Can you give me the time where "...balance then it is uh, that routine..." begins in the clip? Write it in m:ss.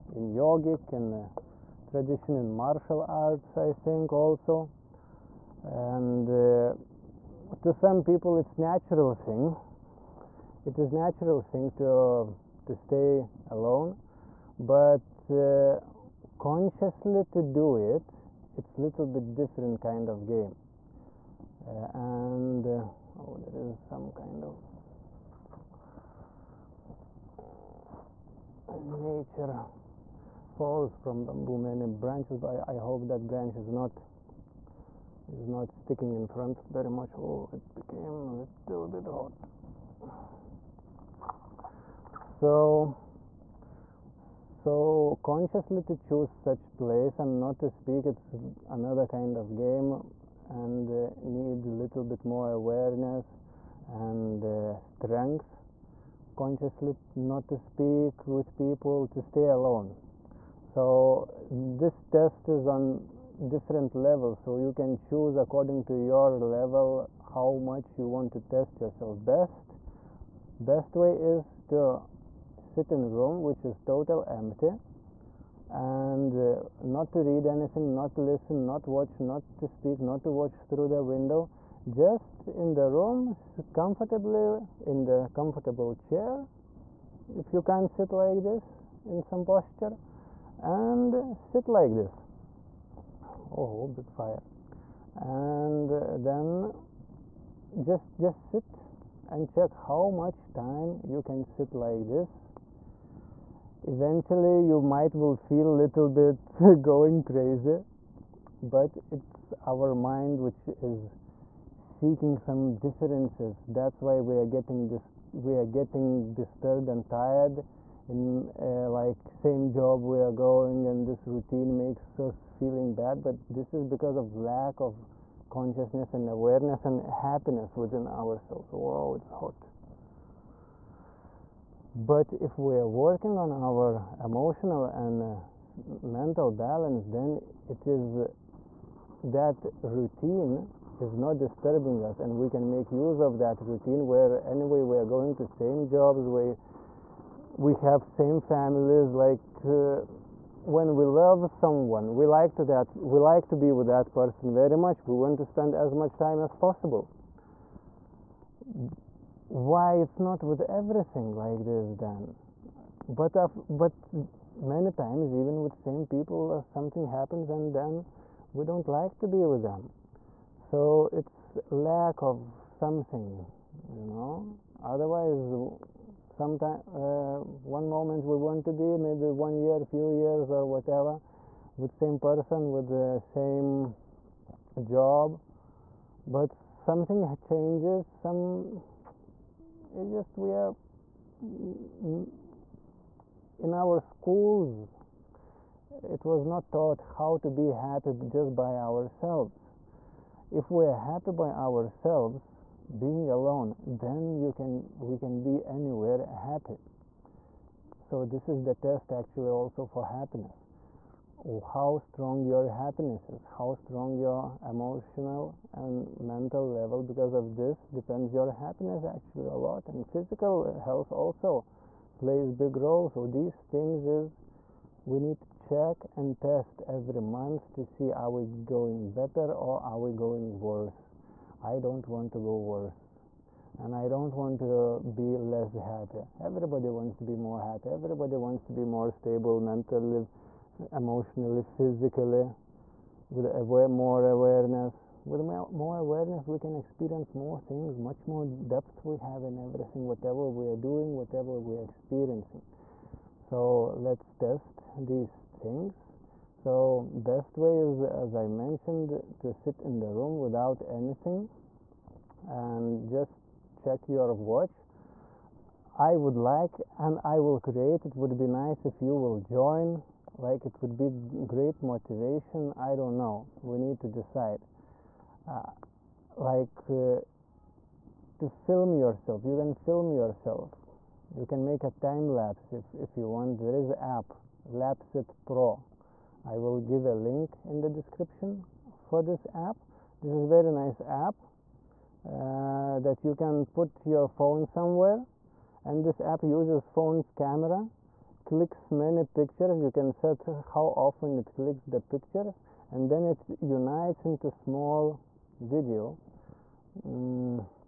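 2:16.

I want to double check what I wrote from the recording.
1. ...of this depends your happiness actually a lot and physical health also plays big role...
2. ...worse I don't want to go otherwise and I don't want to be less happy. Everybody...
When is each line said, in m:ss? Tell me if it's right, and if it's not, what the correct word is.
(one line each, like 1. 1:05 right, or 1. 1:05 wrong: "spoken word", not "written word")
1. 3:37 right
2. 3:50 wrong: "worse", not "otherwise".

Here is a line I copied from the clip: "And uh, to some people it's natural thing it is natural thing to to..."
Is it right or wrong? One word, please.
right.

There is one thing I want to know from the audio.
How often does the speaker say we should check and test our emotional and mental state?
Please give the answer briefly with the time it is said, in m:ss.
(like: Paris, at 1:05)
Every month, at 3:46.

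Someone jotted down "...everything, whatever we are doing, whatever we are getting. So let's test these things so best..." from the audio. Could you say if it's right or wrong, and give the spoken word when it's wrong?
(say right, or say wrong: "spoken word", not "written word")
wrong: "experiencing", not "getting".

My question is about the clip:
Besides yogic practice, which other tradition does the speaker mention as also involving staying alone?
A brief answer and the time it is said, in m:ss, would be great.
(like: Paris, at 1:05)
Martial arts, at 0:02.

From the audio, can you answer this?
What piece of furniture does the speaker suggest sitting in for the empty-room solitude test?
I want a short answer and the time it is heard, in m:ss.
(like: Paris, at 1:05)
Comfortable chair, at 1:25.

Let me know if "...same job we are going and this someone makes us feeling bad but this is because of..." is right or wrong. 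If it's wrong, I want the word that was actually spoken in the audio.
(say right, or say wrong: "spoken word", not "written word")
wrong: "routine", not "someone".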